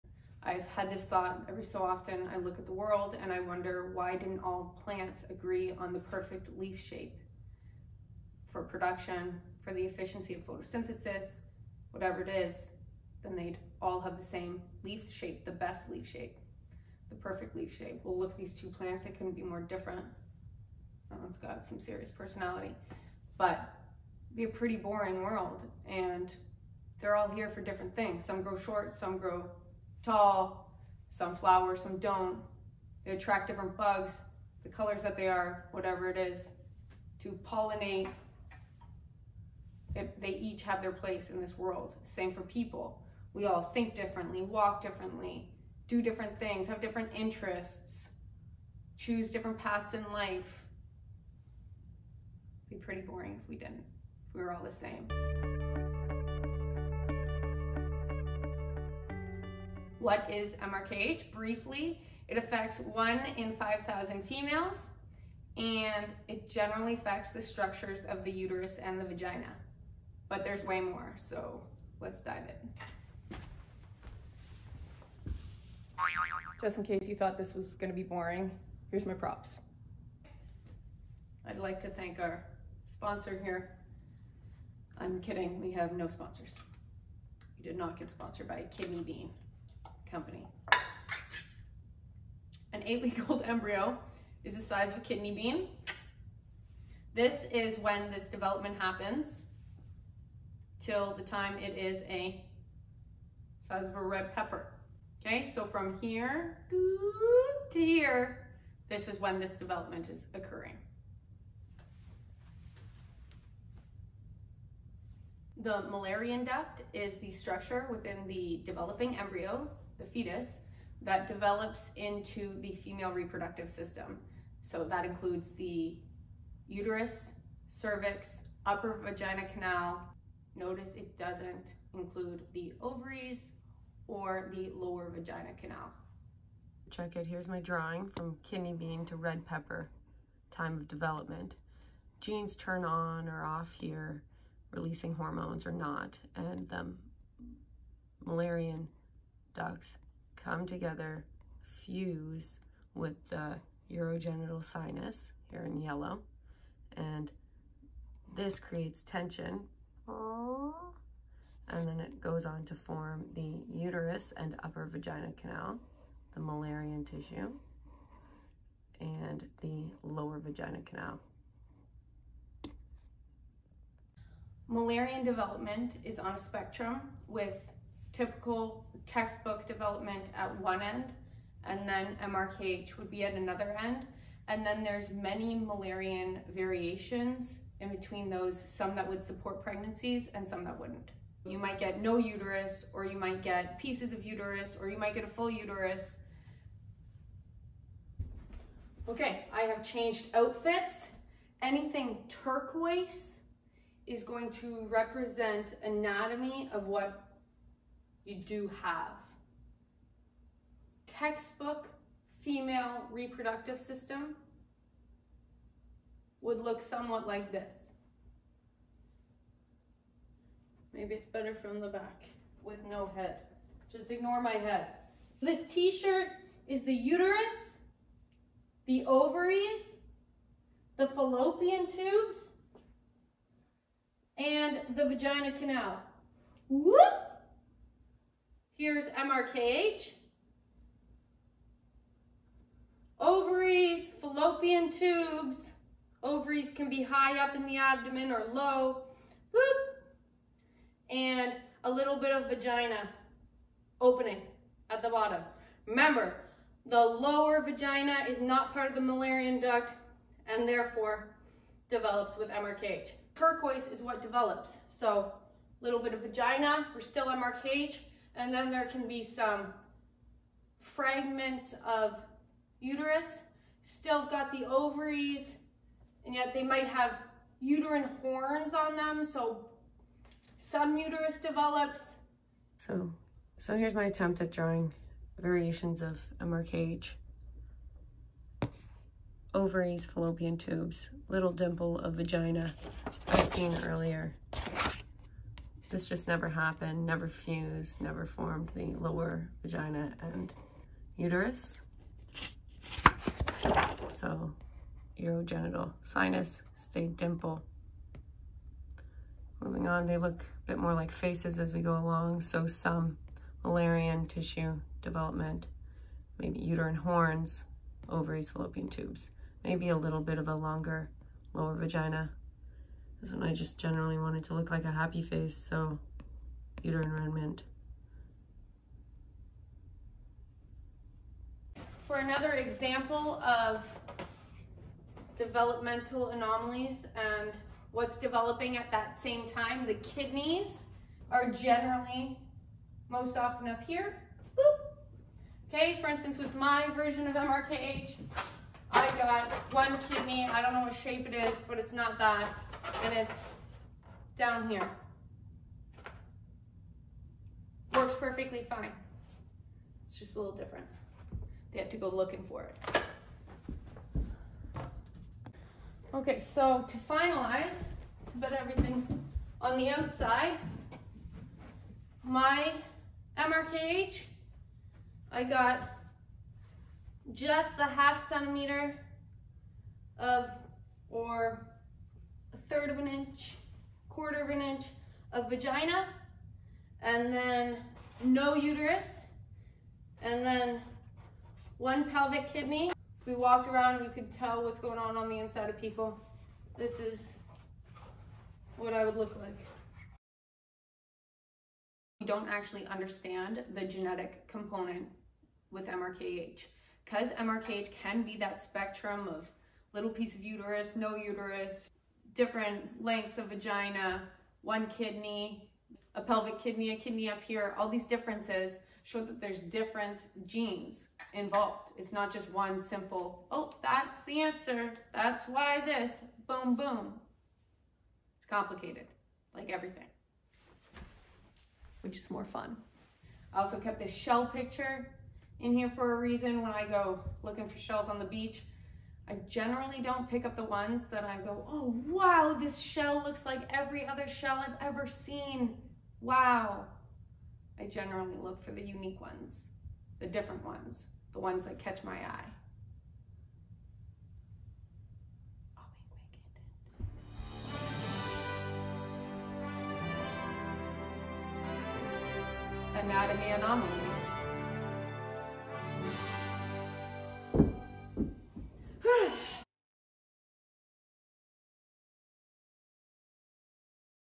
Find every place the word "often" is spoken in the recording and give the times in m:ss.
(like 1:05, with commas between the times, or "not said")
0:01, 5:43.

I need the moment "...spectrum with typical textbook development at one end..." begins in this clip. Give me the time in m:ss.
2:56.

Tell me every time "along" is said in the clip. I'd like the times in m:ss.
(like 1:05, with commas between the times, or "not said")
5:11.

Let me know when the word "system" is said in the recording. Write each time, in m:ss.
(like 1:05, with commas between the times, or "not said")
2:03, 3:33.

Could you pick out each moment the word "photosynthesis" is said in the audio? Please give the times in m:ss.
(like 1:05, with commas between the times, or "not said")
0:10.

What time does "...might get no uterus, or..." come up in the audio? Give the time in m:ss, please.
3:11.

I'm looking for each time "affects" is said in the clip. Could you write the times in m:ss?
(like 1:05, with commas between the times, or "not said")
1:02, 1:06.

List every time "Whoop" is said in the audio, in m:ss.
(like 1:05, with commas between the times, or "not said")
3:56, 4:09.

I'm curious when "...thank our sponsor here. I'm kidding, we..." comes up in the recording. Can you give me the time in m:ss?
1:21.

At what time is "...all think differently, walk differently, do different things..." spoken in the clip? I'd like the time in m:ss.
0:43.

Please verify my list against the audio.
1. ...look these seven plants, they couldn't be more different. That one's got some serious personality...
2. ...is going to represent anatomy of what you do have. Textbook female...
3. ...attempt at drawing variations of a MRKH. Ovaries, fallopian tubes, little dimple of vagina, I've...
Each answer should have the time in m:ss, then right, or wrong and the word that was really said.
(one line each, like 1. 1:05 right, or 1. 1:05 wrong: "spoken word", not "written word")
1. 0:18 wrong: "two", not "seven"
2. 3:24 right
3. 4:44 wrong: "Cage", not "MRKH".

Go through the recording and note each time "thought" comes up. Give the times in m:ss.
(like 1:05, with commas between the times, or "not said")
0:01, 1:17.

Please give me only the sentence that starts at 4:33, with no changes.
Still got the ovaries, and yet they might have uterine horns on them.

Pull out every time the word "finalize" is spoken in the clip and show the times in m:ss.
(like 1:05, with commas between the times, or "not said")
6:06.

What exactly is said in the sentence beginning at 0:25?
And they're all here for different things.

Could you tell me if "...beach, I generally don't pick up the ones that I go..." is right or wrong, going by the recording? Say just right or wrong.
right.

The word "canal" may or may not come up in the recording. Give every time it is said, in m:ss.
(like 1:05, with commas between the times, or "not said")
2:09, 2:15, 2:45, 2:50, 3:55.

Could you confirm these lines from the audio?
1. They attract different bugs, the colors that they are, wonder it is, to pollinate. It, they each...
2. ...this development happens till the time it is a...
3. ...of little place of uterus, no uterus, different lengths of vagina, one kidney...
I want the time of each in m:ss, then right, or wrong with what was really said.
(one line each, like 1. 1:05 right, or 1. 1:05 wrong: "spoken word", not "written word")
1. 0:33 wrong: "whatever", not "wonder"
2. 1:38 right
3. 6:49 wrong: "piece", not "place".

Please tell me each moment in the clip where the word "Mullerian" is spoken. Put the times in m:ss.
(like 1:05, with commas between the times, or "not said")
1:55, 2:46, 2:54, 3:05, 4:19, 5:13.